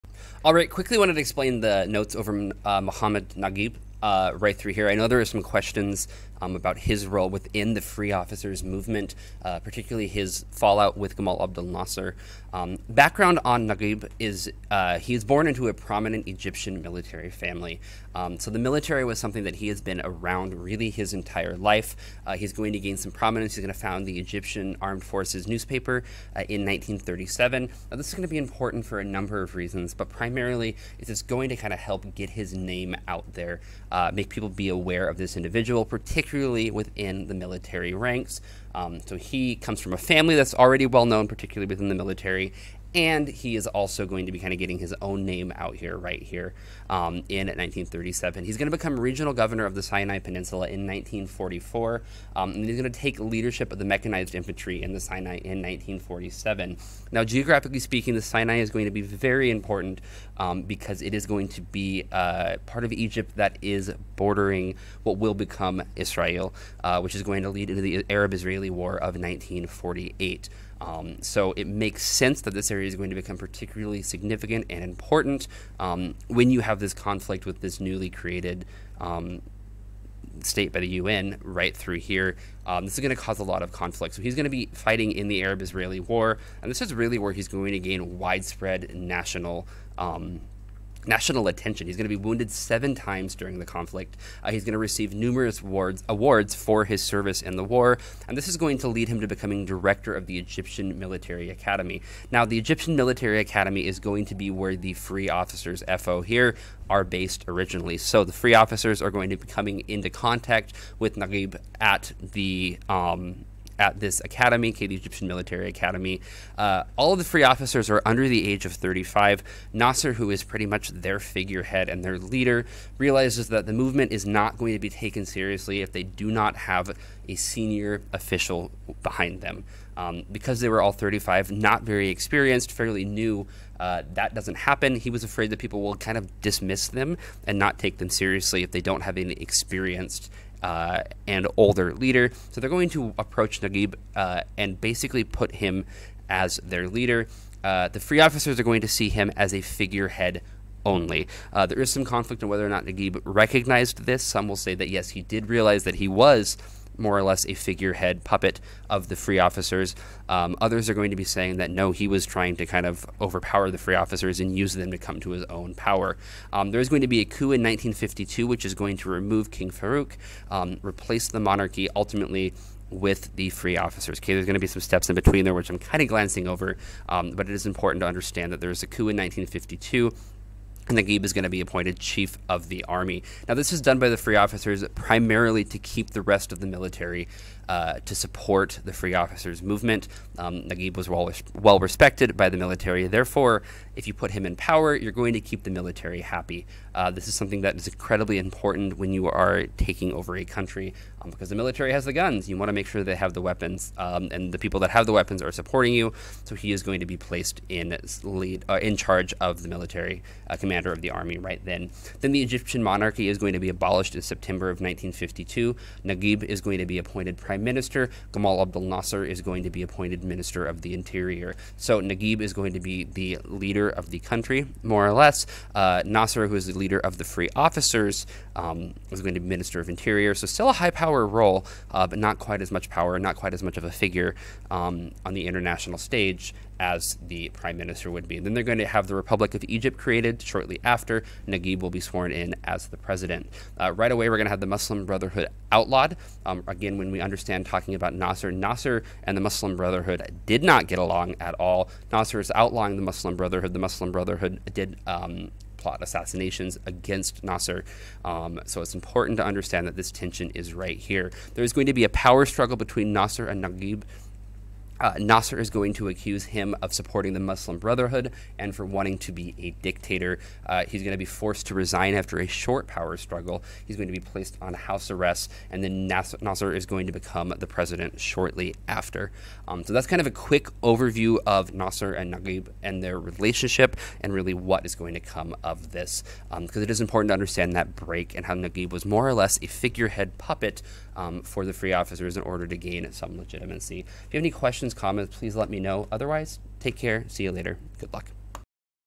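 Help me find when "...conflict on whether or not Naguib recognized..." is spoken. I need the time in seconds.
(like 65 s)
152 s.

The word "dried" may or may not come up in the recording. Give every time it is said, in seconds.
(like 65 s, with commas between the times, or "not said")
not said.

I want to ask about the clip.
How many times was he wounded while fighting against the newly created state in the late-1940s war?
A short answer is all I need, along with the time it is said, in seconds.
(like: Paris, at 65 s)
7, at 92 s.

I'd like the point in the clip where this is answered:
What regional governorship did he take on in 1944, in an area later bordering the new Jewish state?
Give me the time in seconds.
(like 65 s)
49 s.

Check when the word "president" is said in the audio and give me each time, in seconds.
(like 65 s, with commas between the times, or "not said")
242 s, 277 s.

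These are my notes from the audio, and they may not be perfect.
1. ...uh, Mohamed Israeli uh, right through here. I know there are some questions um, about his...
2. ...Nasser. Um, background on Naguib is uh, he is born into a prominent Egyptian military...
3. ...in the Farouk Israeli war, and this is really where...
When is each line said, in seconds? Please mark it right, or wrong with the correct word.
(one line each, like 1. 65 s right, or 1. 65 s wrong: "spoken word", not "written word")
1. 2 s wrong: "Naguib", not "Israeli"
2. 11 s right
3. 85 s wrong: "Arab", not "Farouk".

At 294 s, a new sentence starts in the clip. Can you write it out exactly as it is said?
If you have any questions questions, comments, please let me know.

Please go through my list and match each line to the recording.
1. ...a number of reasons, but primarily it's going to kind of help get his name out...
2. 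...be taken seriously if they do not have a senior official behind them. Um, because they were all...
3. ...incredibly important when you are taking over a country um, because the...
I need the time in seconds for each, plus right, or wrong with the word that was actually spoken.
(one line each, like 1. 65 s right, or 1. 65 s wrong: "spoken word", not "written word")
1. 28 s right
2. 124 s right
3. 197 s right.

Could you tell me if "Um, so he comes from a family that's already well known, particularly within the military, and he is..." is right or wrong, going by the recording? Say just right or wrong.
right.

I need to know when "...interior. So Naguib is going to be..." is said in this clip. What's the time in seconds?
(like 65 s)
220 s.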